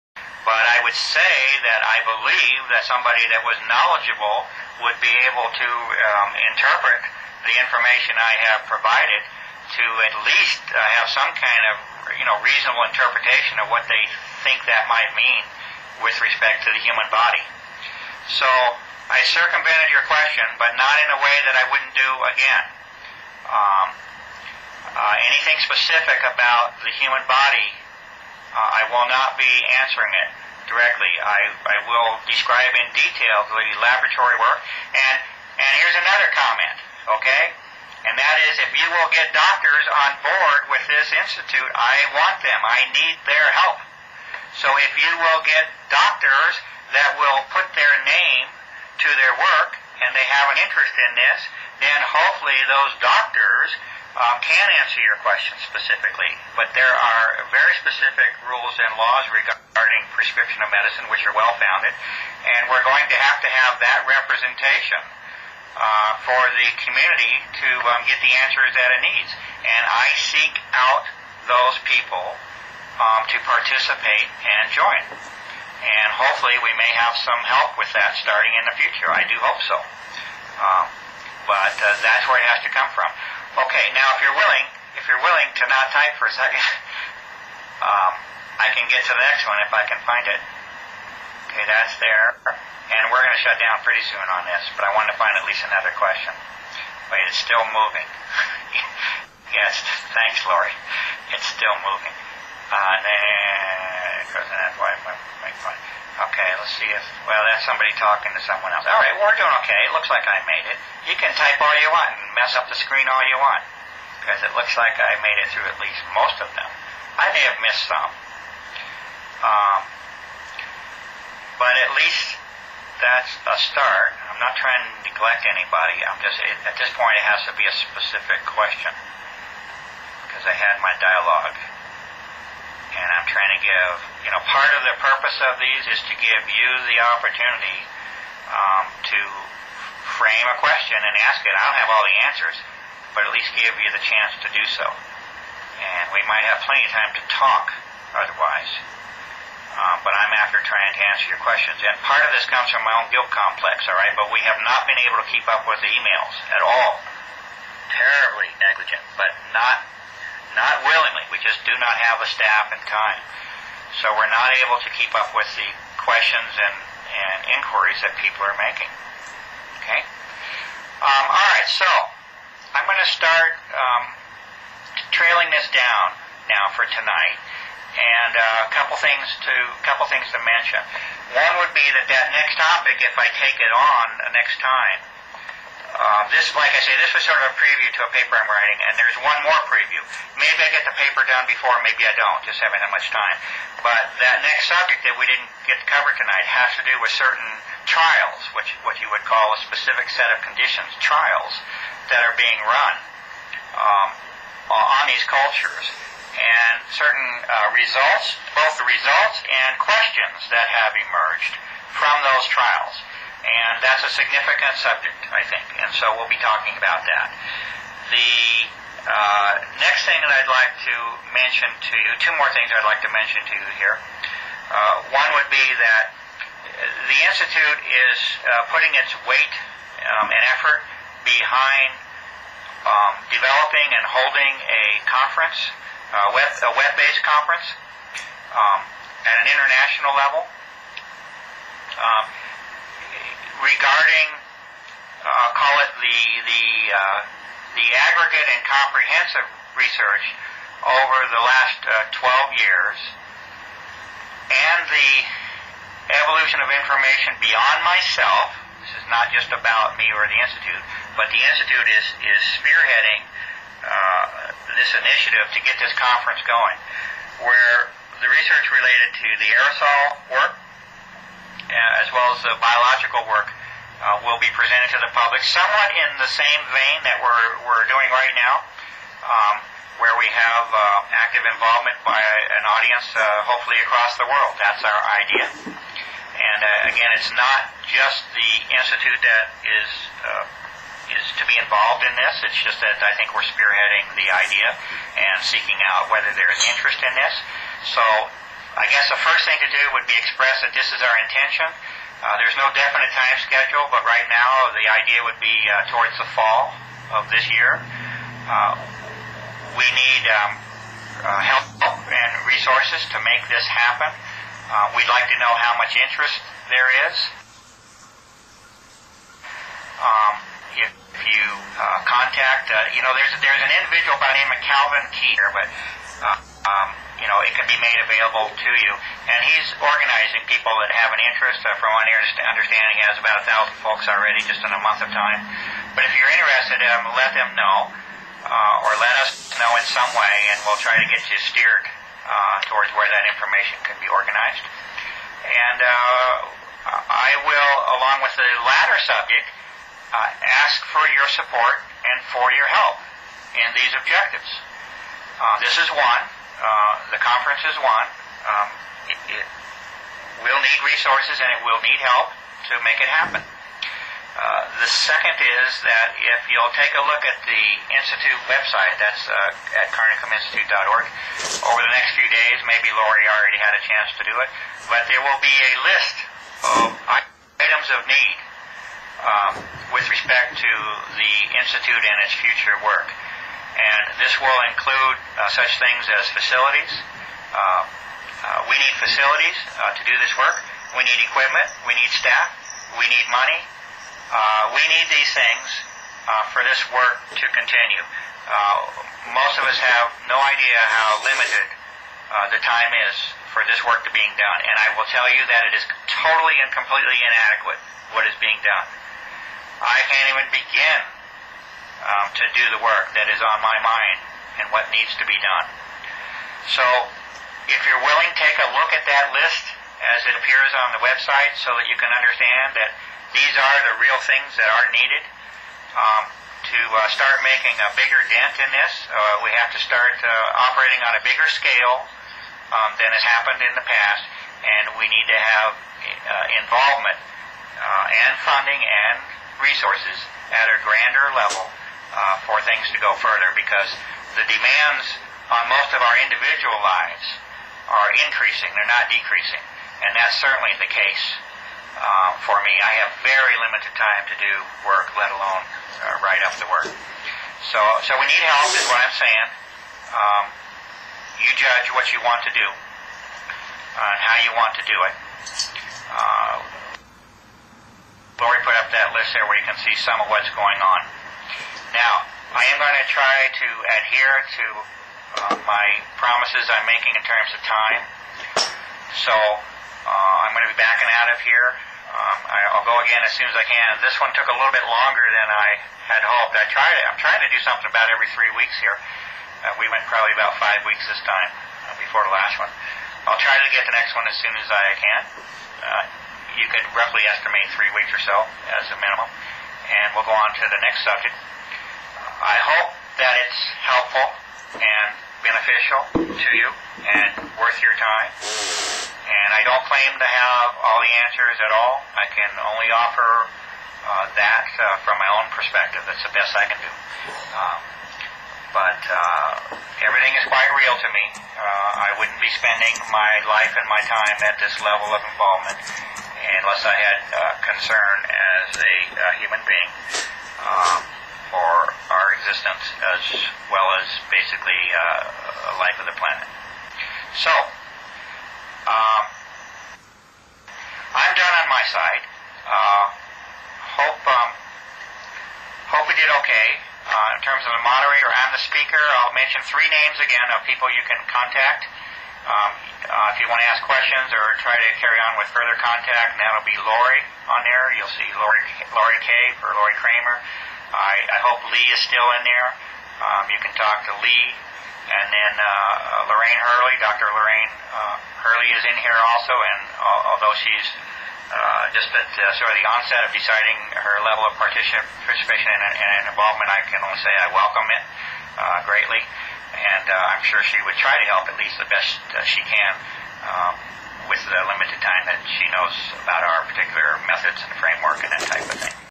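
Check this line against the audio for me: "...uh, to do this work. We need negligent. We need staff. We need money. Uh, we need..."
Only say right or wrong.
wrong.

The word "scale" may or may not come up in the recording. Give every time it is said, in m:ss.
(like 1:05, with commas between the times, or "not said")
7:11.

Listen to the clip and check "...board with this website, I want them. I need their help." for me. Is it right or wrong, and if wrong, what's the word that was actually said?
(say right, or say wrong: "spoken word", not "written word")
wrong: "institute", not "website".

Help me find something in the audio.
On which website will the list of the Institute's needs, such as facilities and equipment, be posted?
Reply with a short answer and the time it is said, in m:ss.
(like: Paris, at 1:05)
carnicominstitute.org, at 6:09.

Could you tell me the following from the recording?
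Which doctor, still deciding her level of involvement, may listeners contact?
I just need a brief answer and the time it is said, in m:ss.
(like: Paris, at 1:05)
Lorraine Hurley, at 9:26.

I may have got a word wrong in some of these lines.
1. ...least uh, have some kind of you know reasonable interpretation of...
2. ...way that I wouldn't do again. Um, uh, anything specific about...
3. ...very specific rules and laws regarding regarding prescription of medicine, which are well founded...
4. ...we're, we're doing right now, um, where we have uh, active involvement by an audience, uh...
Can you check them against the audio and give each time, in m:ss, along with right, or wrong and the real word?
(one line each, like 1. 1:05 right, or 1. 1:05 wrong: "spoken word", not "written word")
1. 0:10 right
2. 0:21 right
3. 0:57 right
4. 4:37 right.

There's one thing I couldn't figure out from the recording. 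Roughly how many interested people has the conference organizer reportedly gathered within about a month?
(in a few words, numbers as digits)
1000.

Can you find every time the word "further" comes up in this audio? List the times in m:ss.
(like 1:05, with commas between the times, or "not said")
7:23, 9:15.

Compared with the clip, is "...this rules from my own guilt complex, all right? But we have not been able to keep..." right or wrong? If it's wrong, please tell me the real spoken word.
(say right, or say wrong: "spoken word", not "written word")
wrong: "comes", not "rules".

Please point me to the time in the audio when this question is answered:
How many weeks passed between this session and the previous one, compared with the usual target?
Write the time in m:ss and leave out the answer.
8:10.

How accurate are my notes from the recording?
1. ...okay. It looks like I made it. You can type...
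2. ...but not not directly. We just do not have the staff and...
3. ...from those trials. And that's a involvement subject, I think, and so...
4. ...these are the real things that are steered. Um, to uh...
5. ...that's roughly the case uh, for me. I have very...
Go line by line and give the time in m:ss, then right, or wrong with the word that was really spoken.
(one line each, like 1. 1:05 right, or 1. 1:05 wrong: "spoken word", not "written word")
1. 1:49 right
2. 2:39 wrong: "willingly", not "directly"
3. 3:31 wrong: "significant", not "involvement"
4. 7:03 wrong: "needed", not "steered"
5. 7:30 wrong: "certainly", not "roughly".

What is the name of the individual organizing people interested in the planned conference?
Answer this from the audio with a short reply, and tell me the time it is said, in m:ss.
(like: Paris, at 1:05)
Calvin Keeter, at 5:24.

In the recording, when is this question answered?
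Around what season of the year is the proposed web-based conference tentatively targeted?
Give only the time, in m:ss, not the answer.
5:06.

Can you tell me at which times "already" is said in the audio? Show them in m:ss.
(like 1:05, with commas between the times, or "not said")
5:34, 6:13.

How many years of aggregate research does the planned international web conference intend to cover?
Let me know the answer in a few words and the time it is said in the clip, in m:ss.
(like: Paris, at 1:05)
12, at 4:12.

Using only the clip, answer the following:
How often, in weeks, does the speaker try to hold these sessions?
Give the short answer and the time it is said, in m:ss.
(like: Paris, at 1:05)
3, at 8:08.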